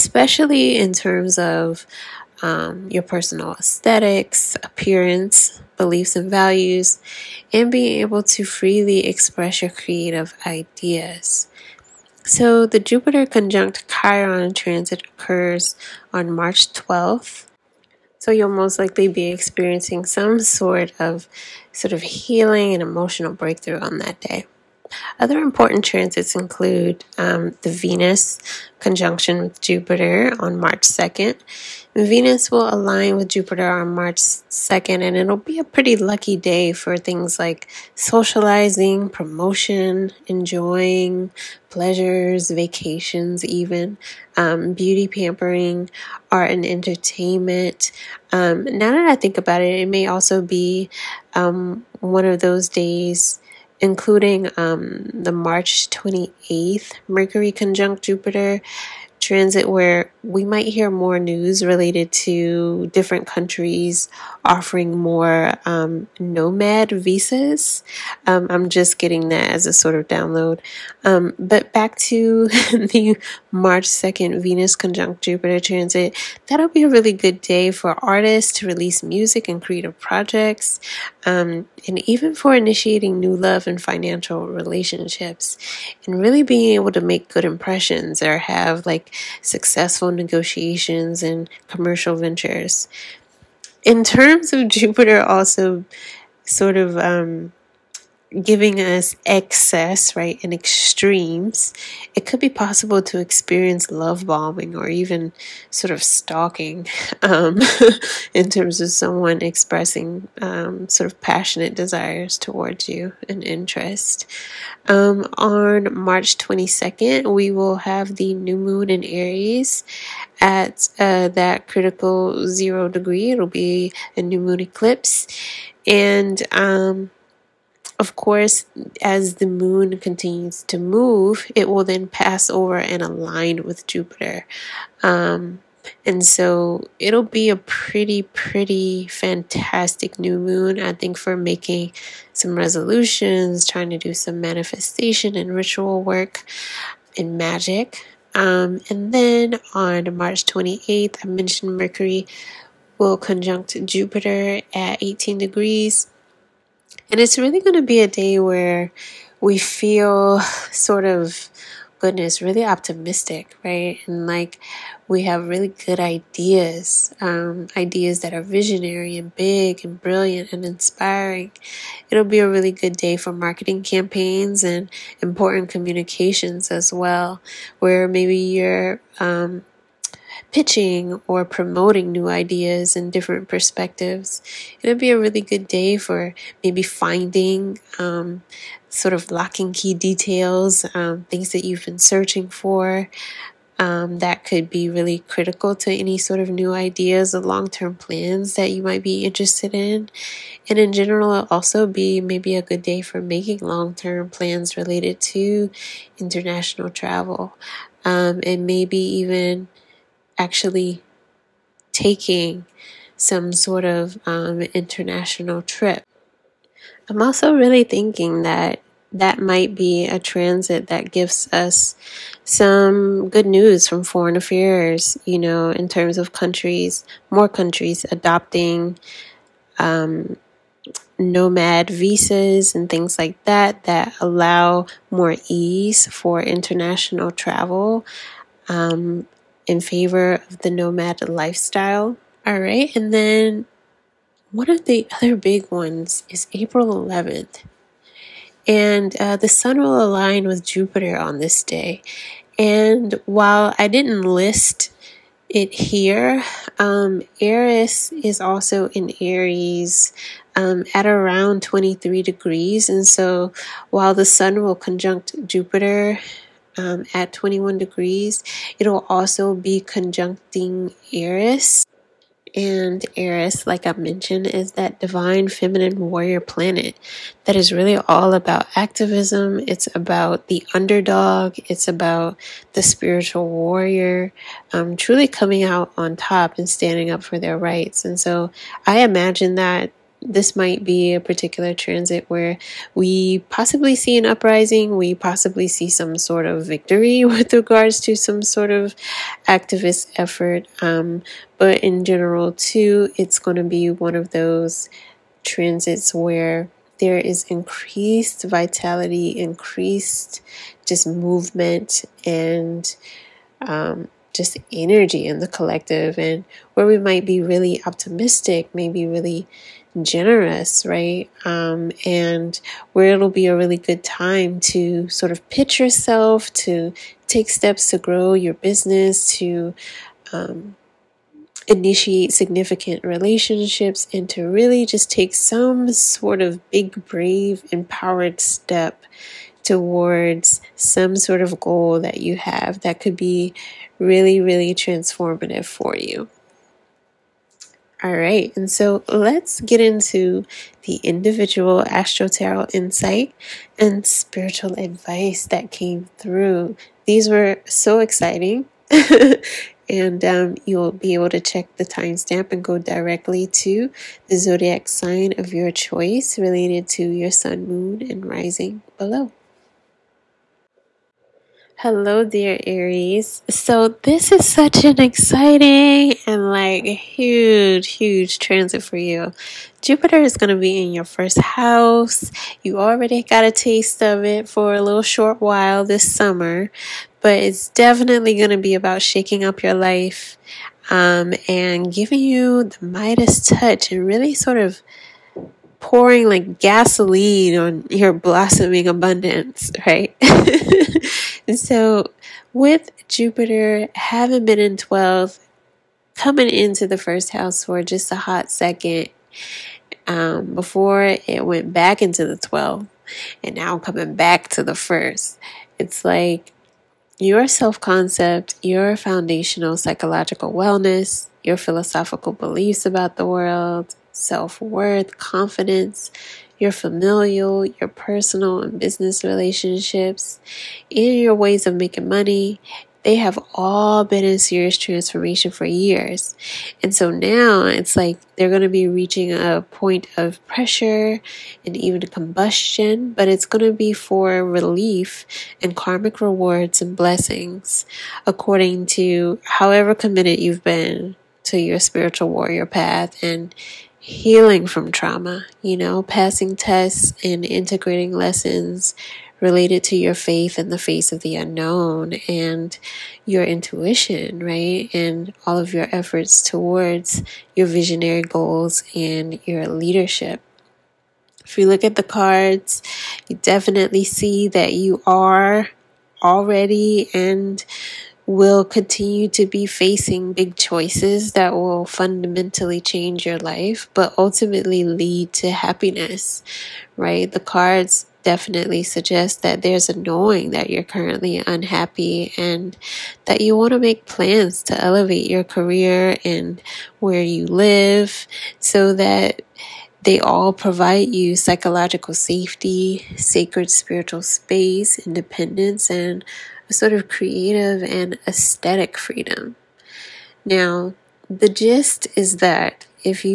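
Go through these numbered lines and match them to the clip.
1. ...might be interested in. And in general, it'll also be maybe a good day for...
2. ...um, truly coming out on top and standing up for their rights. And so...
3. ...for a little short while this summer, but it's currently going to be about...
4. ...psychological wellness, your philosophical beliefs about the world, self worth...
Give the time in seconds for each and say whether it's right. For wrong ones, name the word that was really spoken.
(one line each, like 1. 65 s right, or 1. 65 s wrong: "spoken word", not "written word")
1. 198 s right
2. 284 s right
3. 384 s wrong: "definitely", not "currently"
4. 419 s right.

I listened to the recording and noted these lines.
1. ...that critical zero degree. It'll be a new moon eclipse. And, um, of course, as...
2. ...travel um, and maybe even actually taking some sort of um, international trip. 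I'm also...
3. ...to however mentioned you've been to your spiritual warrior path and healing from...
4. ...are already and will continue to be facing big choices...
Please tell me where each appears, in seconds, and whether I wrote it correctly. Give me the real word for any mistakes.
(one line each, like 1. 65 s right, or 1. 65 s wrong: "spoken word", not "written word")
1. 121 s right
2. 206 s right
3. 448 s wrong: "committed", not "mentioned"
4. 475 s right.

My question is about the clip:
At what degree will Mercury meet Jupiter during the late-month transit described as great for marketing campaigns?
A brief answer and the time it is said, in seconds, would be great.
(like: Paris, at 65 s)
18 degrees, at 155 s.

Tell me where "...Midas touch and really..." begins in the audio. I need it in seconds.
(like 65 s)
392 s.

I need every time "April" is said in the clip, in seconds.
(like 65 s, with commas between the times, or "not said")
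246 s.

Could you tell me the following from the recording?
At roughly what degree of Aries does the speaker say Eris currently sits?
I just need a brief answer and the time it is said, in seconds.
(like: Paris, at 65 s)
23 degrees, at 261 s.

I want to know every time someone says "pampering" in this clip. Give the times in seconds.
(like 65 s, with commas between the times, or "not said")
45 s.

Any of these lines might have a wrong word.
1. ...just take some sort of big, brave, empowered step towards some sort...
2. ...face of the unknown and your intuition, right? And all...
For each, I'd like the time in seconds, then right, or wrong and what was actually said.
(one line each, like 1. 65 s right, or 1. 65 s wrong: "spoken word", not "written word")
1. 334 s right
2. 460 s right.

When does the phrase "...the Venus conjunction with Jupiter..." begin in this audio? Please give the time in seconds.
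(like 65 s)
27 s.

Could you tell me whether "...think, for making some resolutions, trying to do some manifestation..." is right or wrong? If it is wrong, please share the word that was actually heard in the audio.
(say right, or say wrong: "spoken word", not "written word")
right.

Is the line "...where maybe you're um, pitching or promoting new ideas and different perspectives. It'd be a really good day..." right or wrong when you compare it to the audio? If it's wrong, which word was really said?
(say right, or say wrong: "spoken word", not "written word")
right.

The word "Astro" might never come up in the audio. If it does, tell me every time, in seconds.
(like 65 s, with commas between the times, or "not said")
351 s.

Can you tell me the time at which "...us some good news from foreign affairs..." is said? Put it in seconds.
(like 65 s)
221 s.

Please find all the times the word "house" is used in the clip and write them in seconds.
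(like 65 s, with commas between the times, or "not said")
381 s, 407 s.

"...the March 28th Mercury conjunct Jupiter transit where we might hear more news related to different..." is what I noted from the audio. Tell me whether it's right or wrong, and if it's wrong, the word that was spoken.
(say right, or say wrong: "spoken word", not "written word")
right.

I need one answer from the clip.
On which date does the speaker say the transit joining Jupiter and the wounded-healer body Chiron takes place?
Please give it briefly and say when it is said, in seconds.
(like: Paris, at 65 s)
March 12, at 16 s.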